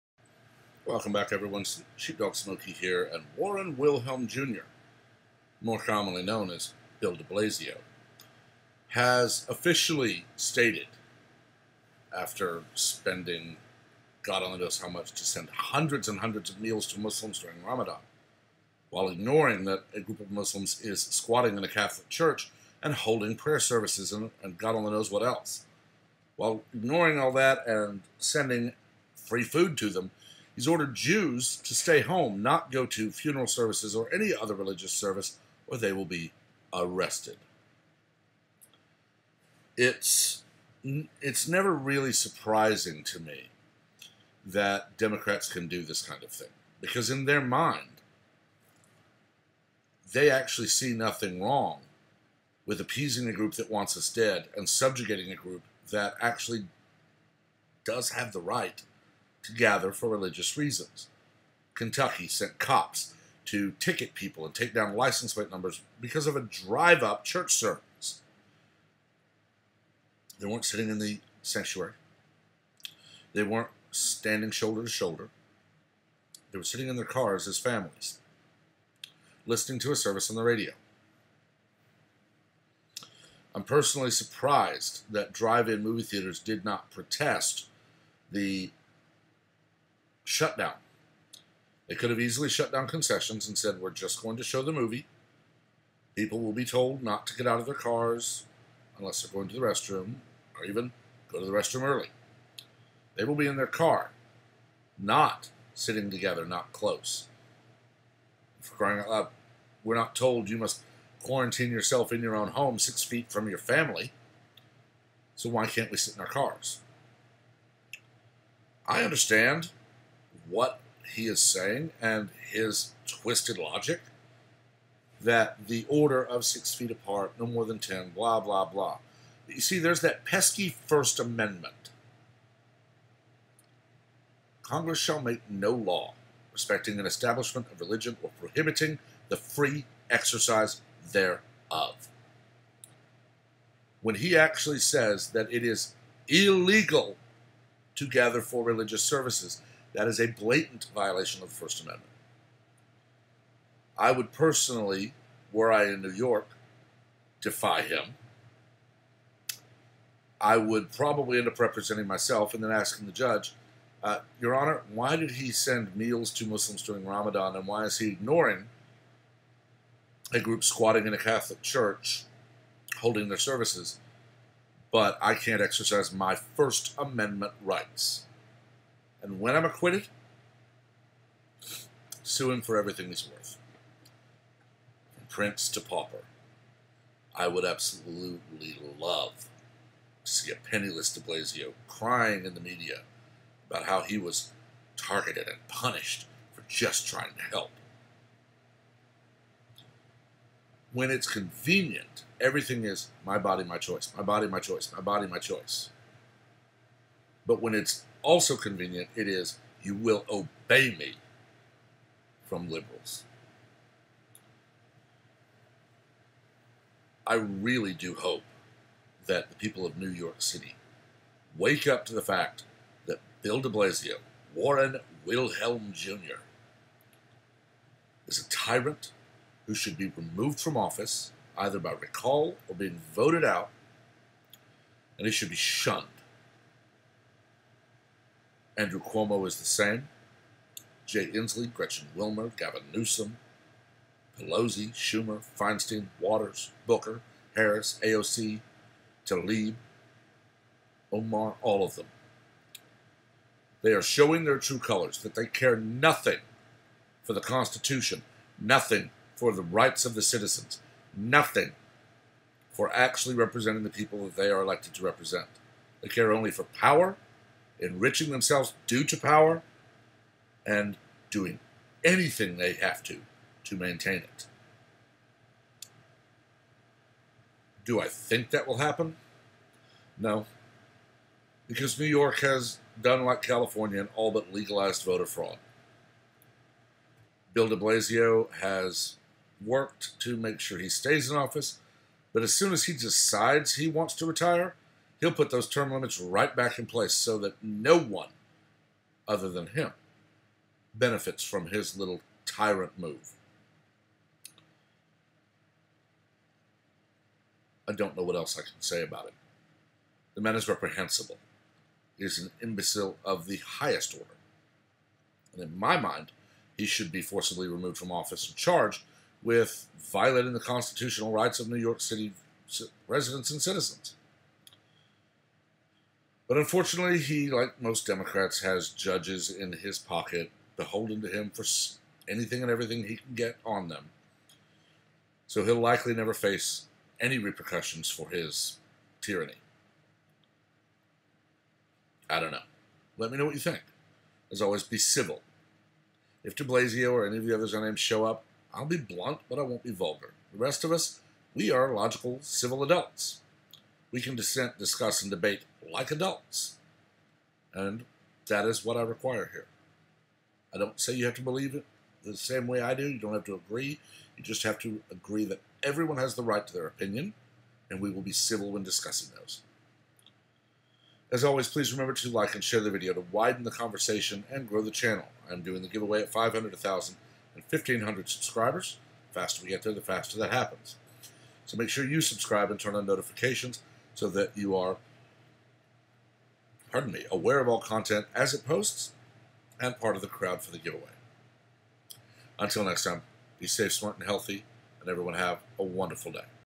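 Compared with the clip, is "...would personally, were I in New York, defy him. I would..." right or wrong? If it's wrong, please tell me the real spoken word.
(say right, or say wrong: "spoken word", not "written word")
right.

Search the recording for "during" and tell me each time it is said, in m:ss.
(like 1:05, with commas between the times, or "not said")
0:17, 2:46.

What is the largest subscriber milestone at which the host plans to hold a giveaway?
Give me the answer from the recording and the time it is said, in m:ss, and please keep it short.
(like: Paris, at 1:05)
1,500, at 6:17.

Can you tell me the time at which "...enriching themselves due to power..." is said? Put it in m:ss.
4:27.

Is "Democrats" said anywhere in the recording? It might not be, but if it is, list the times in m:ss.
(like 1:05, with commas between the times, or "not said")
0:44, 5:28.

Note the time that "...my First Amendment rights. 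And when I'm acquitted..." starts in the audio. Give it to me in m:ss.
2:56.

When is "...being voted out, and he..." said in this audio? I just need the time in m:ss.
3:52.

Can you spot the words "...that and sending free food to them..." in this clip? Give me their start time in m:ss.
0:27.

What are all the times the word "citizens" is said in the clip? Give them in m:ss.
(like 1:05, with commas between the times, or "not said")
4:20, 5:23.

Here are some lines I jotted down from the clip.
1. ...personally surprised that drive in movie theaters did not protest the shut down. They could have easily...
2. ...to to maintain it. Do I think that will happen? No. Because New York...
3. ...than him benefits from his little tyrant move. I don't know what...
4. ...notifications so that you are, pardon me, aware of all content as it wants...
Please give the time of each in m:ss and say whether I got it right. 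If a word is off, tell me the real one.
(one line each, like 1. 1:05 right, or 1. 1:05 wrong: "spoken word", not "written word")
1. 1:23 right
2. 4:33 right
3. 4:59 right
4. 6:23 wrong: "posts", not "wants".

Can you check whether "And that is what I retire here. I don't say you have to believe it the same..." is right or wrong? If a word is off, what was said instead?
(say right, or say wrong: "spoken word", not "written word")
wrong: "require", not "retire".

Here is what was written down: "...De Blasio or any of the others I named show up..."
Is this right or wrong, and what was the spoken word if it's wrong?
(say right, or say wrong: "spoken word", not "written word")
right.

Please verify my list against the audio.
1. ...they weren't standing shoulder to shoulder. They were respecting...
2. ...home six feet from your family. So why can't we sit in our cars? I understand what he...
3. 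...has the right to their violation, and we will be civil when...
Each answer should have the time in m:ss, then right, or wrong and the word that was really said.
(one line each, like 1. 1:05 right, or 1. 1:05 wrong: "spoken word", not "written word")
1. 1:13 wrong: "sitting", not "respecting"
2. 1:52 right
3. 6:06 wrong: "opinion", not "violation".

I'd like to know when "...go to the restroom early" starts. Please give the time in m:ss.
1:41.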